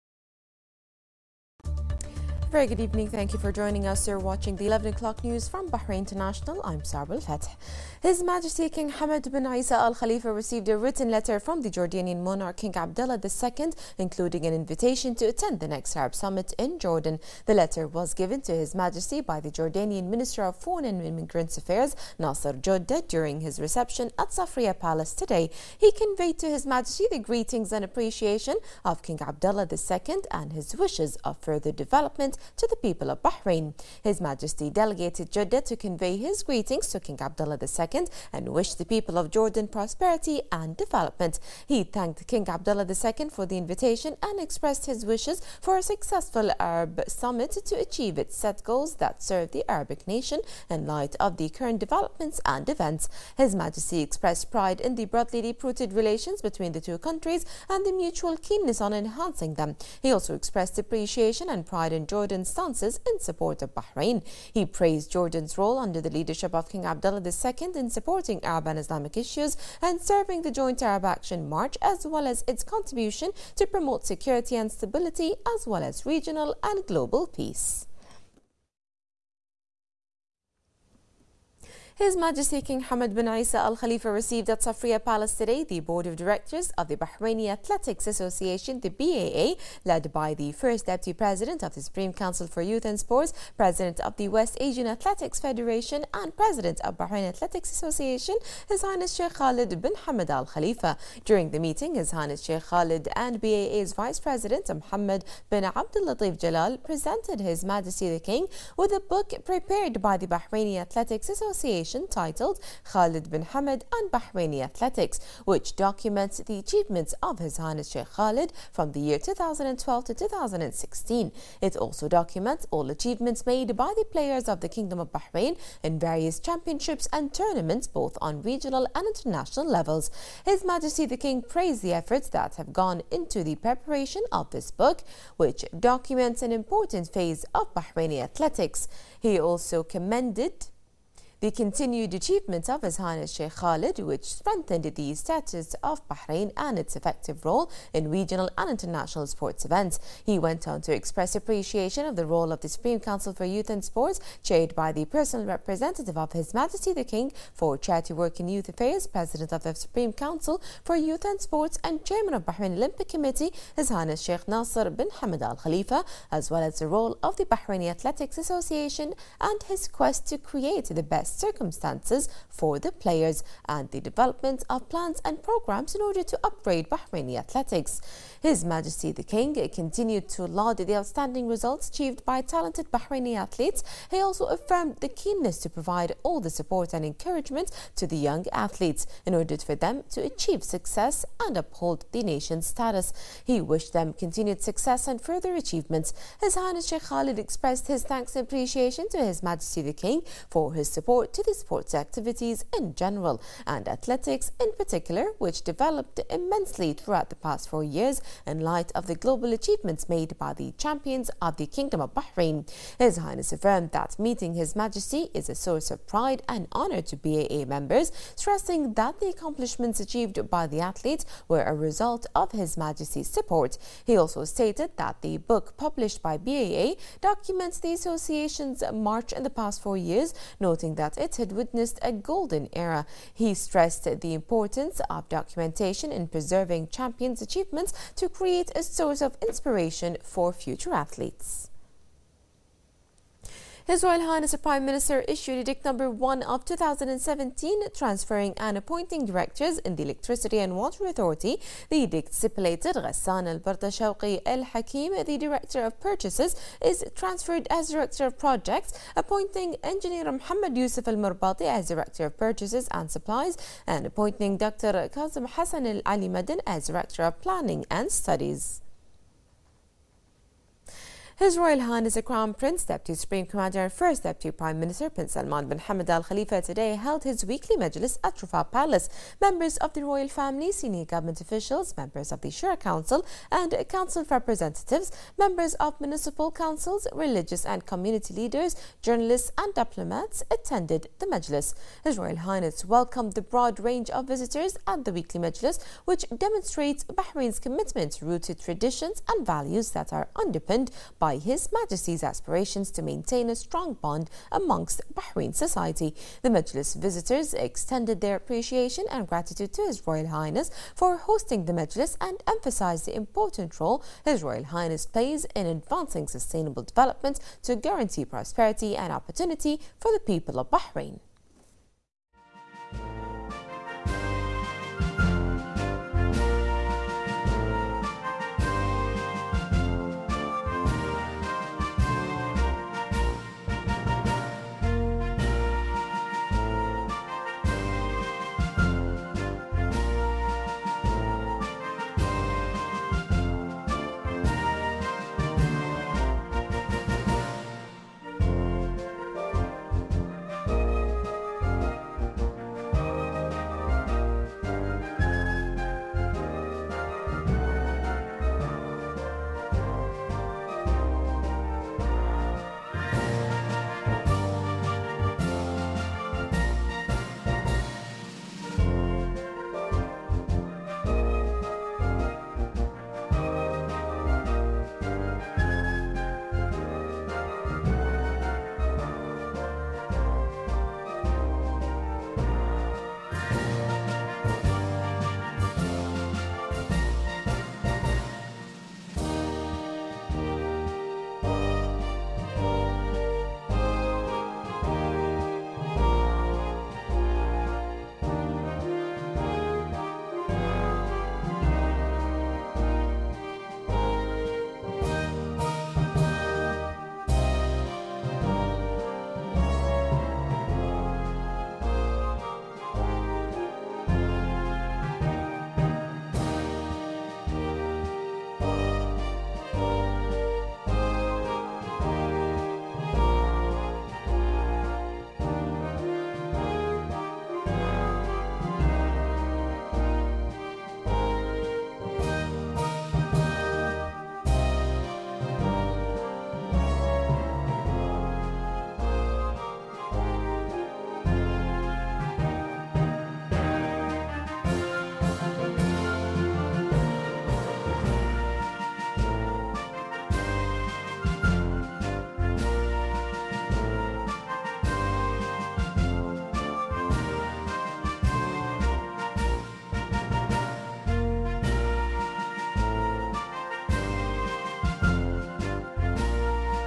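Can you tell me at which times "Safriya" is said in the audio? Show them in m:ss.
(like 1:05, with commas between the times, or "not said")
0:24, 1:24.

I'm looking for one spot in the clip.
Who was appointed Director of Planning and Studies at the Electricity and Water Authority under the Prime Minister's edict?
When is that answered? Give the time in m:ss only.
4:25.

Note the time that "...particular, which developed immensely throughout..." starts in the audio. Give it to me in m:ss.
3:24.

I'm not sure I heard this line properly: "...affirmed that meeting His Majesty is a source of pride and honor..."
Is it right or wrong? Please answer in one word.
right.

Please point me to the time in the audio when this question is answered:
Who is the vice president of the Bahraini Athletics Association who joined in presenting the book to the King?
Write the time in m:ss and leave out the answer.
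1:44.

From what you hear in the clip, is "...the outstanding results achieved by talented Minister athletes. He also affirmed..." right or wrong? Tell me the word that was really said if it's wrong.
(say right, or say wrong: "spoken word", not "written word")
wrong: "Bahraini", not "Minister".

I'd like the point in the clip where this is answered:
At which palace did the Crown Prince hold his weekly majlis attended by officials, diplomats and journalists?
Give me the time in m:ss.
4:38.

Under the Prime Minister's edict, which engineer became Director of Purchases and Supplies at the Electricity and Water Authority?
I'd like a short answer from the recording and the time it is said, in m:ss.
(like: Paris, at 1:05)
Mohammed Yusuf al-Murbati, at 4:20.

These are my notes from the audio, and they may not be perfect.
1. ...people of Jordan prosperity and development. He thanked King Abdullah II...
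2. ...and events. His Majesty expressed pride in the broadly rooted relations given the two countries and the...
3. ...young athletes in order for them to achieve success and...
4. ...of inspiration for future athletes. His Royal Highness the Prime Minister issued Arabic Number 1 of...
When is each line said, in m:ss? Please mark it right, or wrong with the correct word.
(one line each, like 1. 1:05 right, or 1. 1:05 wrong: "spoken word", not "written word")
1. 0:38 right
2. 0:52 wrong: "between", not "given"
3. 3:08 right
4. 3:59 wrong: "Edict", not "Arabic".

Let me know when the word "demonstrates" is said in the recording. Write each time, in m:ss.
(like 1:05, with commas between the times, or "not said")
4:56.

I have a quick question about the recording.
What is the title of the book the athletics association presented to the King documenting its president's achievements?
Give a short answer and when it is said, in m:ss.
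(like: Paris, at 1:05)
Khalid bin Hamad and Bahraini Athletics, at 1:52.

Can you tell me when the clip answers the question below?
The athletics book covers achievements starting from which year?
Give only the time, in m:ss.
1:59.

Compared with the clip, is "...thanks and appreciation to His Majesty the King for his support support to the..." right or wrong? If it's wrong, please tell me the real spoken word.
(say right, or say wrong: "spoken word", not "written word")
right.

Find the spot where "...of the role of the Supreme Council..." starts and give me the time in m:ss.
2:32.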